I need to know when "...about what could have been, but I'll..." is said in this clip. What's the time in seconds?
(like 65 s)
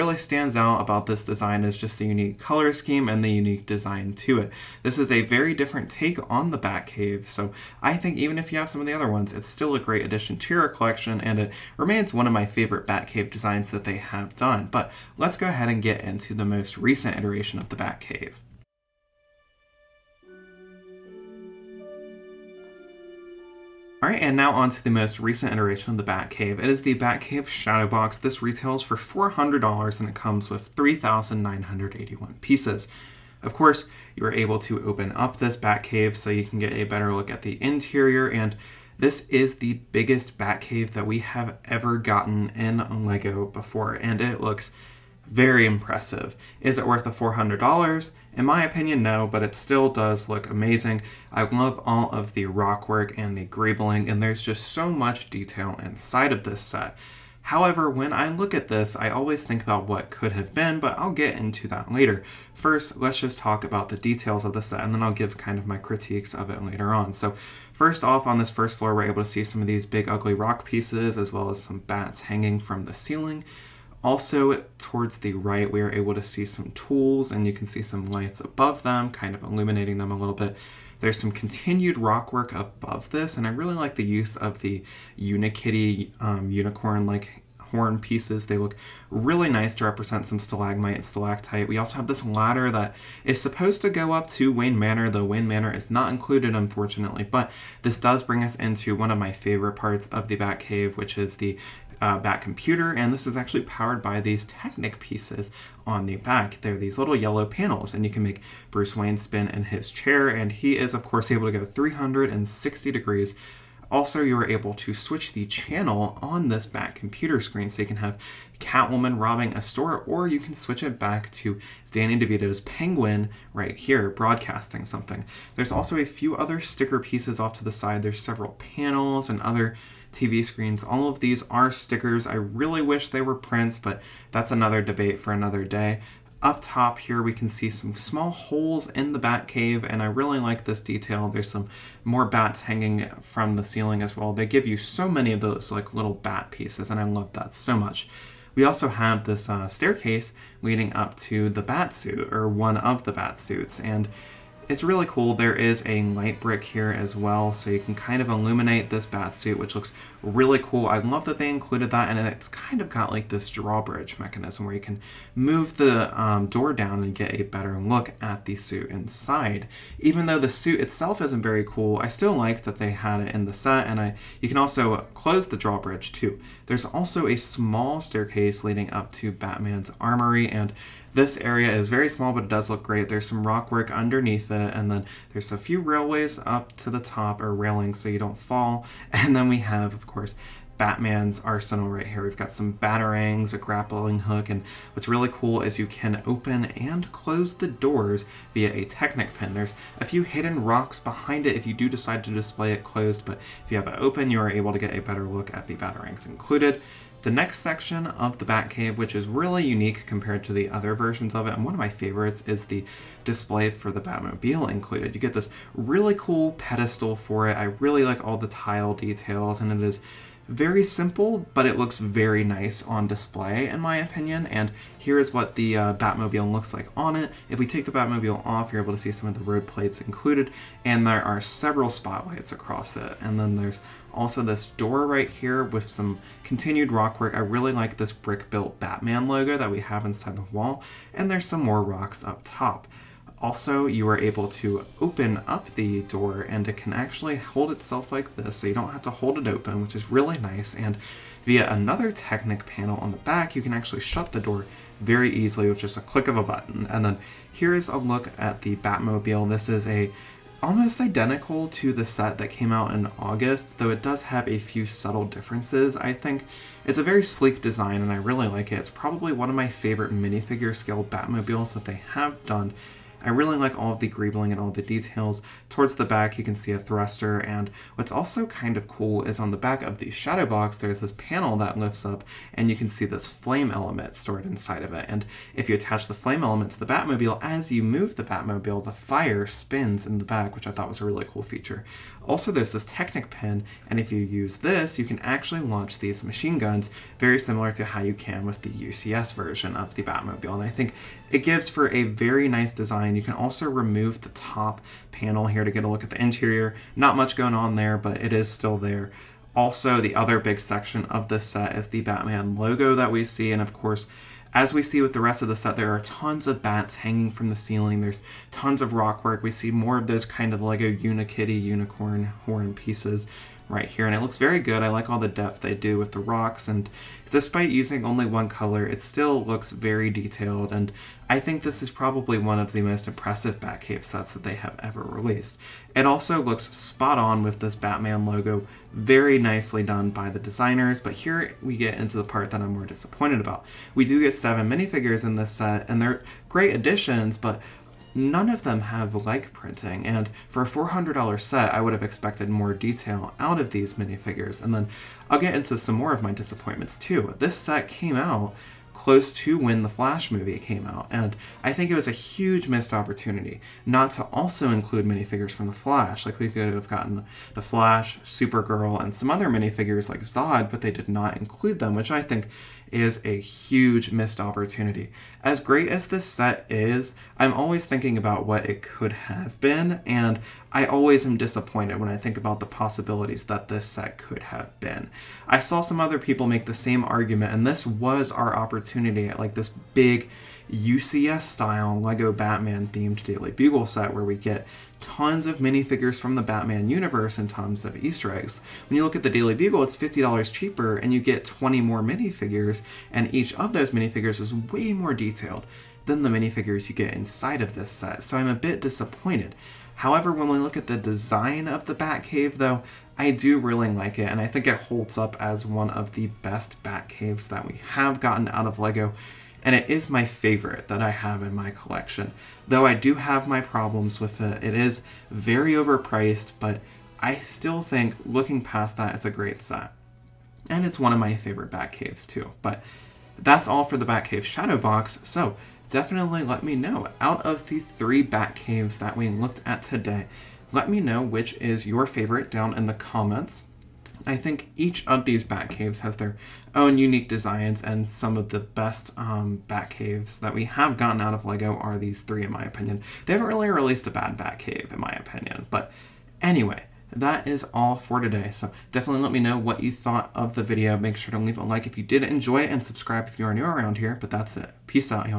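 59 s.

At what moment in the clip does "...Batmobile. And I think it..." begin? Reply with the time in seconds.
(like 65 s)
300 s.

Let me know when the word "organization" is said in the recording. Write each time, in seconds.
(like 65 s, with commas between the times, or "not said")
not said.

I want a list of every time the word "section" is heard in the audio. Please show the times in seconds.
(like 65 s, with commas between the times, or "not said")
207 s, 310 s.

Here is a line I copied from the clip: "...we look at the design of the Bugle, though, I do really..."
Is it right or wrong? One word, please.
wrong.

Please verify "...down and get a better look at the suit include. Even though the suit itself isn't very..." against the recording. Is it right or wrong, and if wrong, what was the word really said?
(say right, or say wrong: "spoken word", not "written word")
wrong: "inside", not "include".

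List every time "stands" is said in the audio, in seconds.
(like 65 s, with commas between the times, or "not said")
0 s.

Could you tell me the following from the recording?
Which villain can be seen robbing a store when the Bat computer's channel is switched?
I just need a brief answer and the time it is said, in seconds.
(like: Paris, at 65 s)
Catwoman, at 118 s.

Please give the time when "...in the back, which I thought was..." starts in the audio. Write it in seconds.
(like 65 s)
290 s.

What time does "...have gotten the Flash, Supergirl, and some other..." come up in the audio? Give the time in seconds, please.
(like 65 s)
366 s.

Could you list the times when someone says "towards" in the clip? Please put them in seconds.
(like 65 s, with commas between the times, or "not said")
74 s, 275 s.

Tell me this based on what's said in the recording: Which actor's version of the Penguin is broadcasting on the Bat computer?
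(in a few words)
Danny DeVito.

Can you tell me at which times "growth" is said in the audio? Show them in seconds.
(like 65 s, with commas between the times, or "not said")
not said.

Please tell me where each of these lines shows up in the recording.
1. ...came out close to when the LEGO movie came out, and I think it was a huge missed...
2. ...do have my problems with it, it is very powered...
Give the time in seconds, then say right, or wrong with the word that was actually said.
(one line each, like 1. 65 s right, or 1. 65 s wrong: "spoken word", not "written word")
1. 357 s wrong: "Flash", not "LEGO"
2. 422 s wrong: "overpriced", not "powered".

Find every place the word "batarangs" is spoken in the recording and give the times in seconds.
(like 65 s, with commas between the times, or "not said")
192 s, 205 s.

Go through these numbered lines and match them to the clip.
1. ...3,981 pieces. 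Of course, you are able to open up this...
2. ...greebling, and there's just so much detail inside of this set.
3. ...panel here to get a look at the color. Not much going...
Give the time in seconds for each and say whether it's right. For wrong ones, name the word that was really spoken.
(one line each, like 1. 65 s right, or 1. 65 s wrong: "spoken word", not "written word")
1. 30 s right
2. 53 s right
3. 305 s wrong: "interior", not "color".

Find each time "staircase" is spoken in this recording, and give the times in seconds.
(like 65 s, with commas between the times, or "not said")
149 s, 177 s.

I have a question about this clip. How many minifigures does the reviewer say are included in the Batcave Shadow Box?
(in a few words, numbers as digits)
7.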